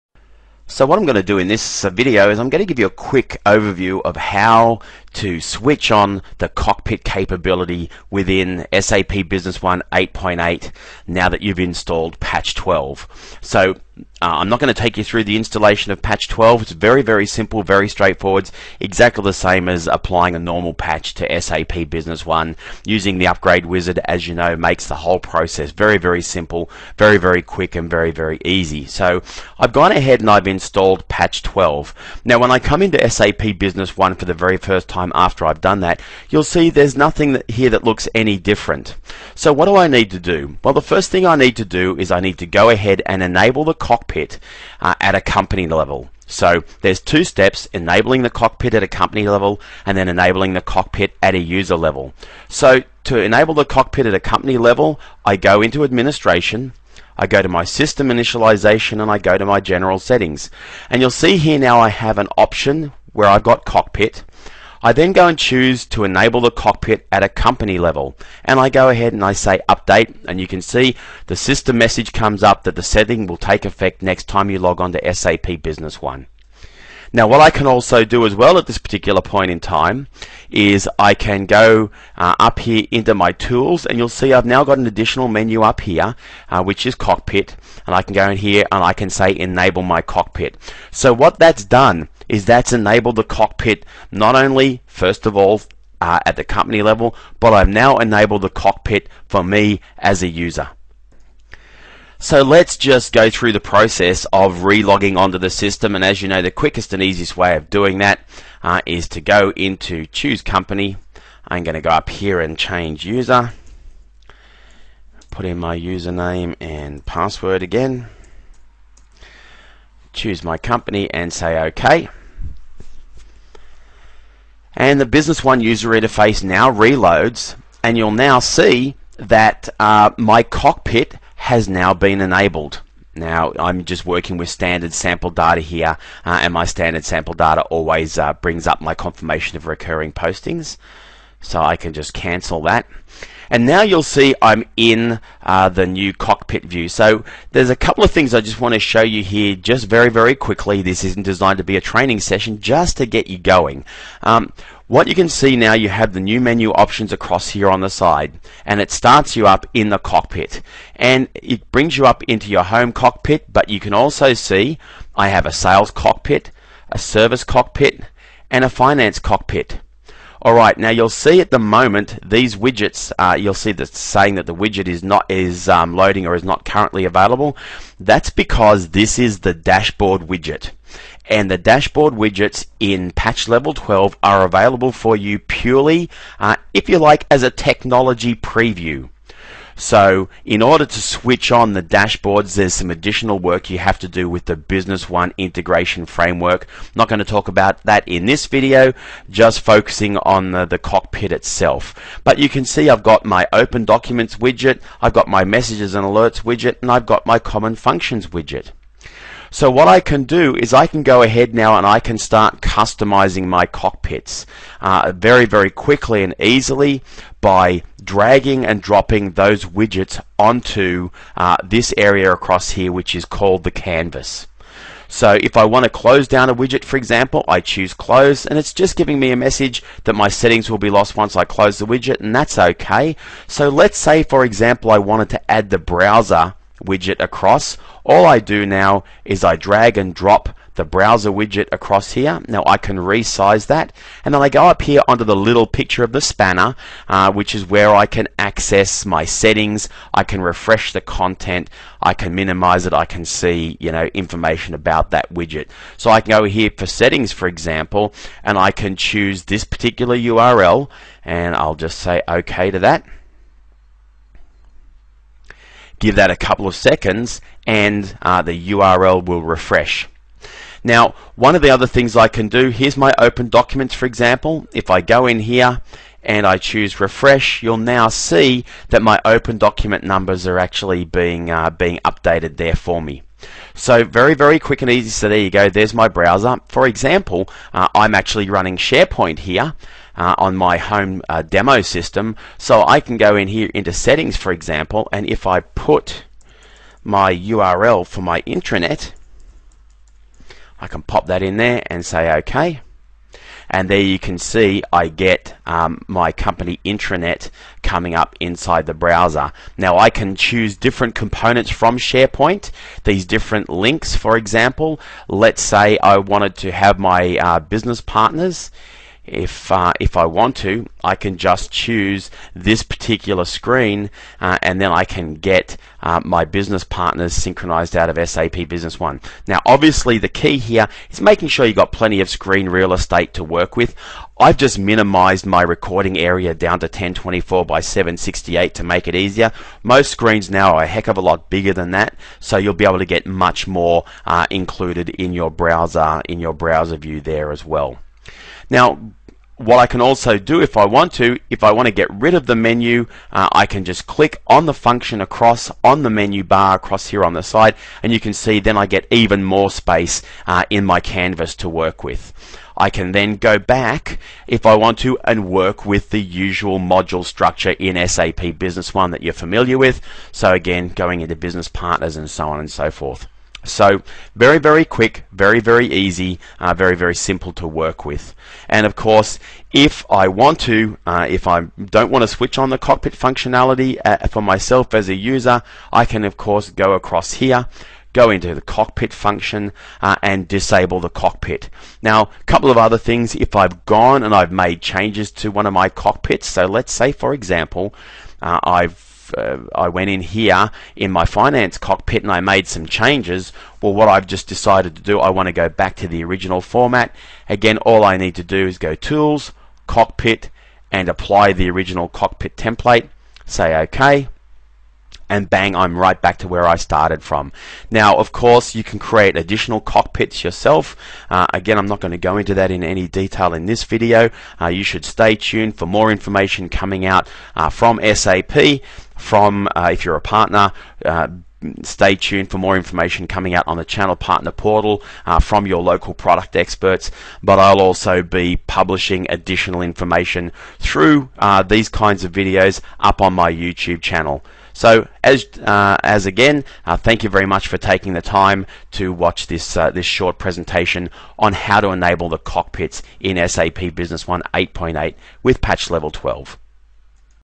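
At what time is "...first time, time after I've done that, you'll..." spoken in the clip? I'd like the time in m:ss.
0:34.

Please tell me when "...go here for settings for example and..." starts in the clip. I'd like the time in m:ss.
4:16.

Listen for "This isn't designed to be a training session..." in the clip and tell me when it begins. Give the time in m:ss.
2:30.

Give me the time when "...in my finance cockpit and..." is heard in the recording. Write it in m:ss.
6:40.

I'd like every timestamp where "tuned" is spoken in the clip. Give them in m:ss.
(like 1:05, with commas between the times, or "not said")
7:05, 7:12.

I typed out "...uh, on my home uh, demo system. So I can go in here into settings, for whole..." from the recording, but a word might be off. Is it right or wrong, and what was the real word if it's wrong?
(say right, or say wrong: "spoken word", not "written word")
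wrong: "example", not "whole".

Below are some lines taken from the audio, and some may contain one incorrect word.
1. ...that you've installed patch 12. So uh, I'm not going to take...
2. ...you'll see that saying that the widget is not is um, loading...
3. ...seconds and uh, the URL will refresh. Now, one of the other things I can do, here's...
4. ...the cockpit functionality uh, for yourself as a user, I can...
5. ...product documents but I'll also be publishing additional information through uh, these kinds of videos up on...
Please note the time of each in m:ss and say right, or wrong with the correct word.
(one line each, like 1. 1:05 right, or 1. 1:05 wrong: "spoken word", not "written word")
1. 0:11 right
2. 2:53 right
3. 4:26 right
4. 6:22 wrong: "myself", not "yourself"
5. 7:16 wrong: "experts", not "documents".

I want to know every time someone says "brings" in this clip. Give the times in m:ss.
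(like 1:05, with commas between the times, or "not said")
2:18, 2:41.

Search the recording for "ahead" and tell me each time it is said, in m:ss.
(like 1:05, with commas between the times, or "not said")
0:29, 0:42, 1:08, 3:31.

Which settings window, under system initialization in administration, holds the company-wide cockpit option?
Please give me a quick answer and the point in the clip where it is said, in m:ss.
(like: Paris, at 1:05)
General settings, at 0:59.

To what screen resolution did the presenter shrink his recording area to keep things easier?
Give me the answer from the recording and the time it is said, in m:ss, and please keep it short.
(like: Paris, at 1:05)
1024 by 768, at 5:36.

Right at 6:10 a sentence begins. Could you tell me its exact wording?
So again, going into business partners and so on and so forth.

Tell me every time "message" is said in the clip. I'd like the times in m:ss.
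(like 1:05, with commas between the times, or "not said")
1:11, 3:25, 3:49.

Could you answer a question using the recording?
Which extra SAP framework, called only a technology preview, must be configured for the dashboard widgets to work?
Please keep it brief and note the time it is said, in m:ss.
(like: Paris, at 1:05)
Business One integration framework, at 3:14.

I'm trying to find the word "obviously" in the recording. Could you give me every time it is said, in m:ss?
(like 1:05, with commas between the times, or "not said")
5:29.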